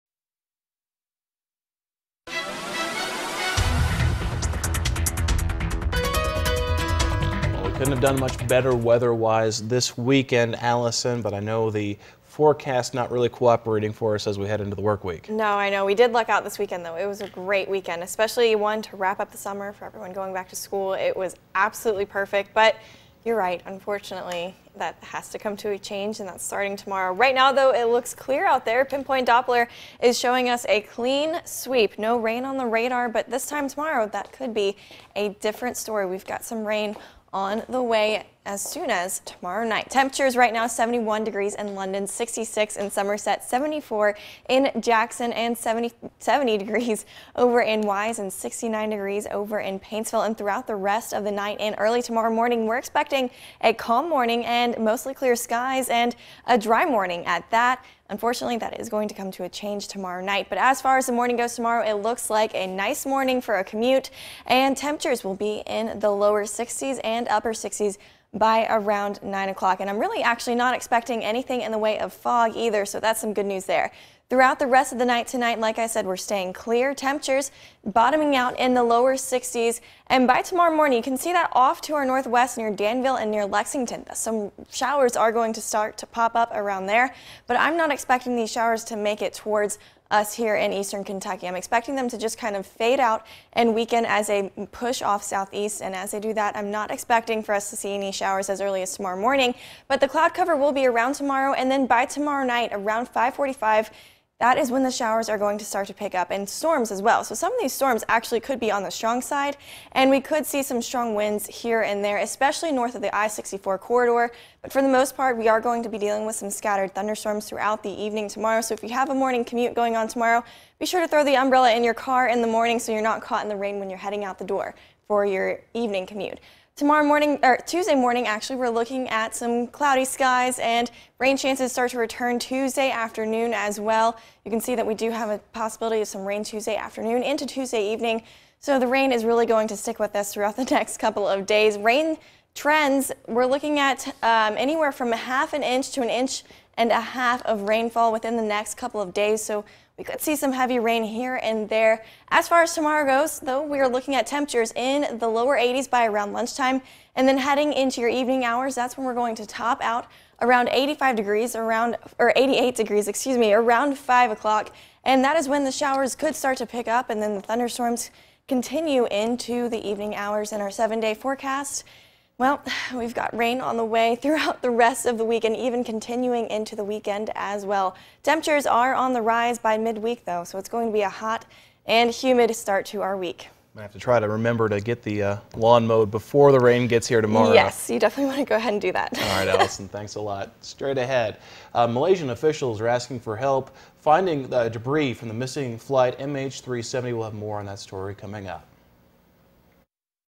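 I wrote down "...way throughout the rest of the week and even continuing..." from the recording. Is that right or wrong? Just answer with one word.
right.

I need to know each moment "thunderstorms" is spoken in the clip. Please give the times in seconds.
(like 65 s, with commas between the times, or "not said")
116 s, 167 s.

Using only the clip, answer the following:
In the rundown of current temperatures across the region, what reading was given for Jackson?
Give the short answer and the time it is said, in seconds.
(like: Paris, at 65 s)
74 degrees, at 43 s.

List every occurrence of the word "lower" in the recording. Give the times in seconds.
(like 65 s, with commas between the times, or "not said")
66 s, 78 s, 155 s.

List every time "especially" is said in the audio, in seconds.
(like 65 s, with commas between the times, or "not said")
18 s, 112 s.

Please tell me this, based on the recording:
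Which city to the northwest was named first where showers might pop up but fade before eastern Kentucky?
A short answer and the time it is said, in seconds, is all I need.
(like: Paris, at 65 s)
Danville, at 82 s.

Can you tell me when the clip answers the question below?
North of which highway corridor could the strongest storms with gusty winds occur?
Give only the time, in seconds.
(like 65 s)
113 s.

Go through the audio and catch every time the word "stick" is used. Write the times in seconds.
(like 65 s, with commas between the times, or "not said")
139 s.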